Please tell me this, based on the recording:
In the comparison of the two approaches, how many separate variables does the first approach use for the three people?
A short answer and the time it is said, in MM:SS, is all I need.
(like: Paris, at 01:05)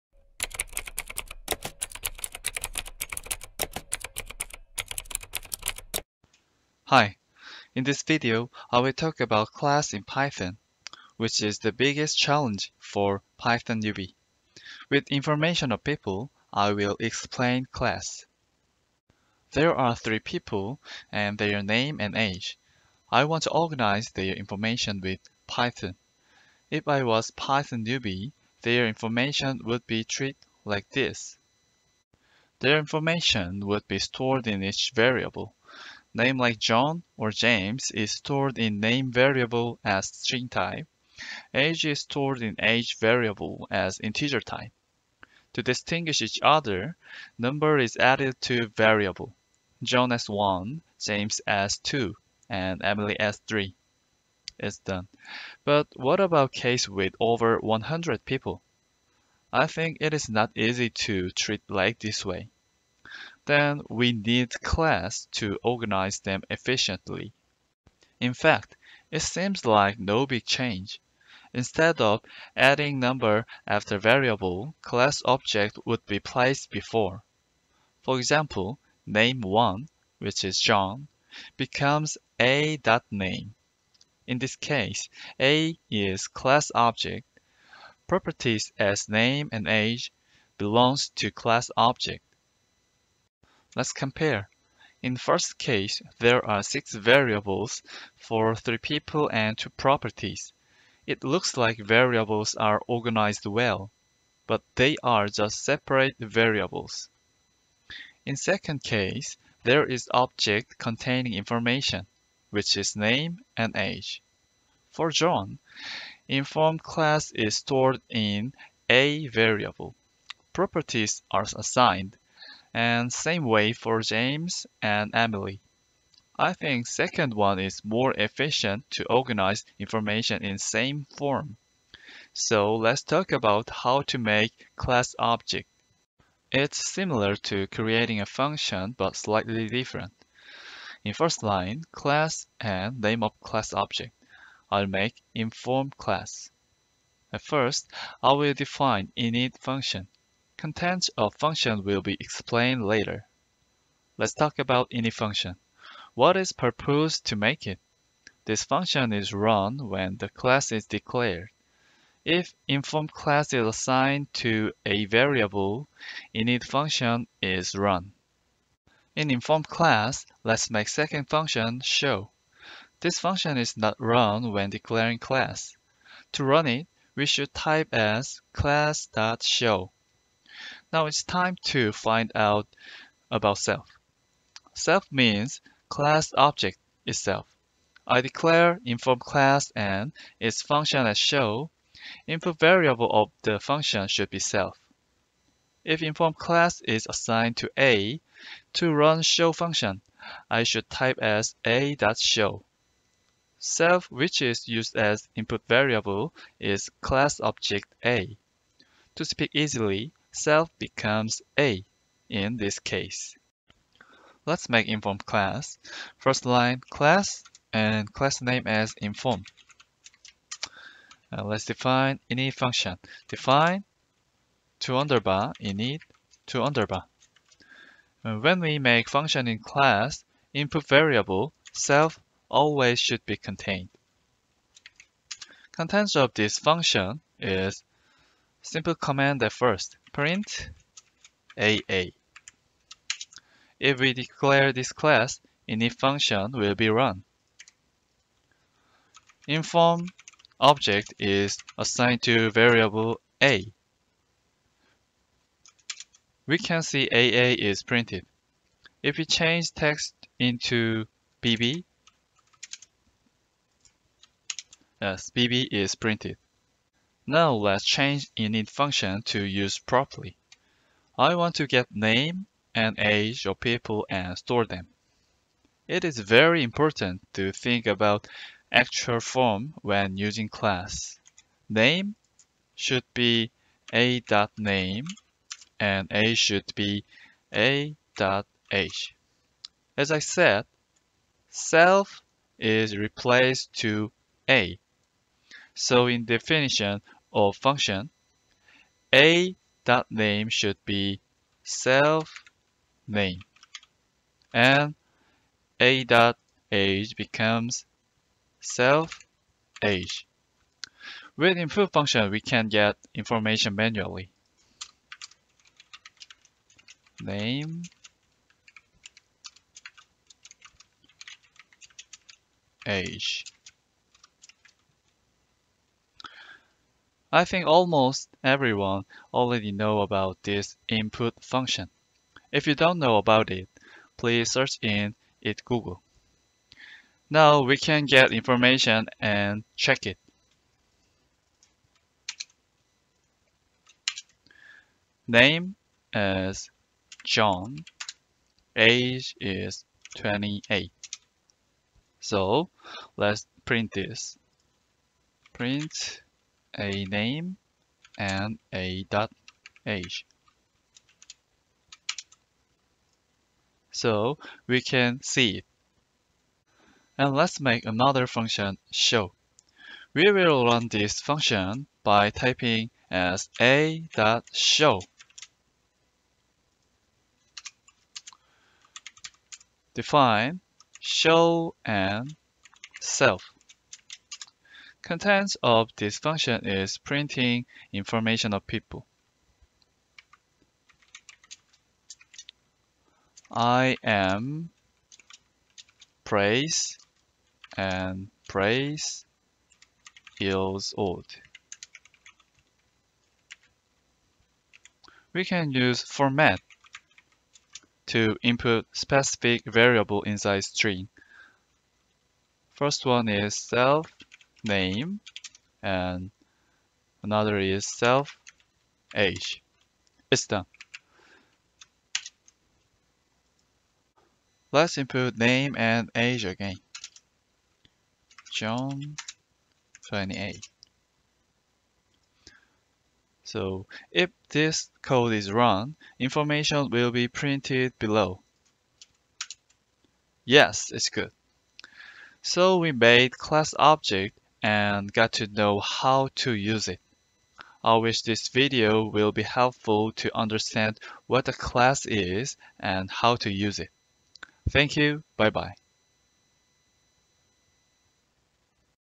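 6, at 01:36.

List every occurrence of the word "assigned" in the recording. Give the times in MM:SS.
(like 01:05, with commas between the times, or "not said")
02:01, 02:43, 03:17, 04:11.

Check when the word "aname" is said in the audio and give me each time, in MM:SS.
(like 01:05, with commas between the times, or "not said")
01:22, 04:43.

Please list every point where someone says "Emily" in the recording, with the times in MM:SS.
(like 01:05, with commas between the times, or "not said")
00:52, 02:05.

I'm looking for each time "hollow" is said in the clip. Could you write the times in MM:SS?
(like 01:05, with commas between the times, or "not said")
not said.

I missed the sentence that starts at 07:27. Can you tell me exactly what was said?
I wish this video will be helpful to understand what a class is and how to use it.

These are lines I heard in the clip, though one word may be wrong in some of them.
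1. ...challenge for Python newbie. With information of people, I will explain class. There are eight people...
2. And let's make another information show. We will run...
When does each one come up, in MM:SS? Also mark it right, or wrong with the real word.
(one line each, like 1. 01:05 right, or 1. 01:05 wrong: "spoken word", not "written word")
1. 00:12 wrong: "three", not "eight"
2. 06:07 wrong: "function", not "information".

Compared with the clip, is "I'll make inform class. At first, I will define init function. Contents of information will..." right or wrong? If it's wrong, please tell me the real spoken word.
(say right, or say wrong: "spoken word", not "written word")
wrong: "function", not "information".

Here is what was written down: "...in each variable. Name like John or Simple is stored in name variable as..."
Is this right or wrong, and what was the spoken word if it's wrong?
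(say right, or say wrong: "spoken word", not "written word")
wrong: "James", not "Simple".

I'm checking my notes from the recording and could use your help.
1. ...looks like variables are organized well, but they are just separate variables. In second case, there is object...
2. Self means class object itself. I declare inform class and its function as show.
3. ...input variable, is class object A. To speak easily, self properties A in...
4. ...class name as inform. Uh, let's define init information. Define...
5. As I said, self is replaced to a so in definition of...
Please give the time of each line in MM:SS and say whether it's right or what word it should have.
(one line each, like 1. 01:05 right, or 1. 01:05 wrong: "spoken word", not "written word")
1. 01:41 right
2. 03:04 right
3. 03:25 wrong: "becomes", not "properties"
4. 03:38 wrong: "function", not "information"
5. 04:49 right.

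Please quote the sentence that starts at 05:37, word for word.
Now we can get information and check it.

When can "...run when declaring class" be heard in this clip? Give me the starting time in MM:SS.
02:53.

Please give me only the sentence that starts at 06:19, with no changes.
Define show and self contents of this function is printing information of people.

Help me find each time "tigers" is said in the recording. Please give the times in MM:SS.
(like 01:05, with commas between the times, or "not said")
not said.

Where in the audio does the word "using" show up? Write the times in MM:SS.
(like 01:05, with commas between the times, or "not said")
04:40.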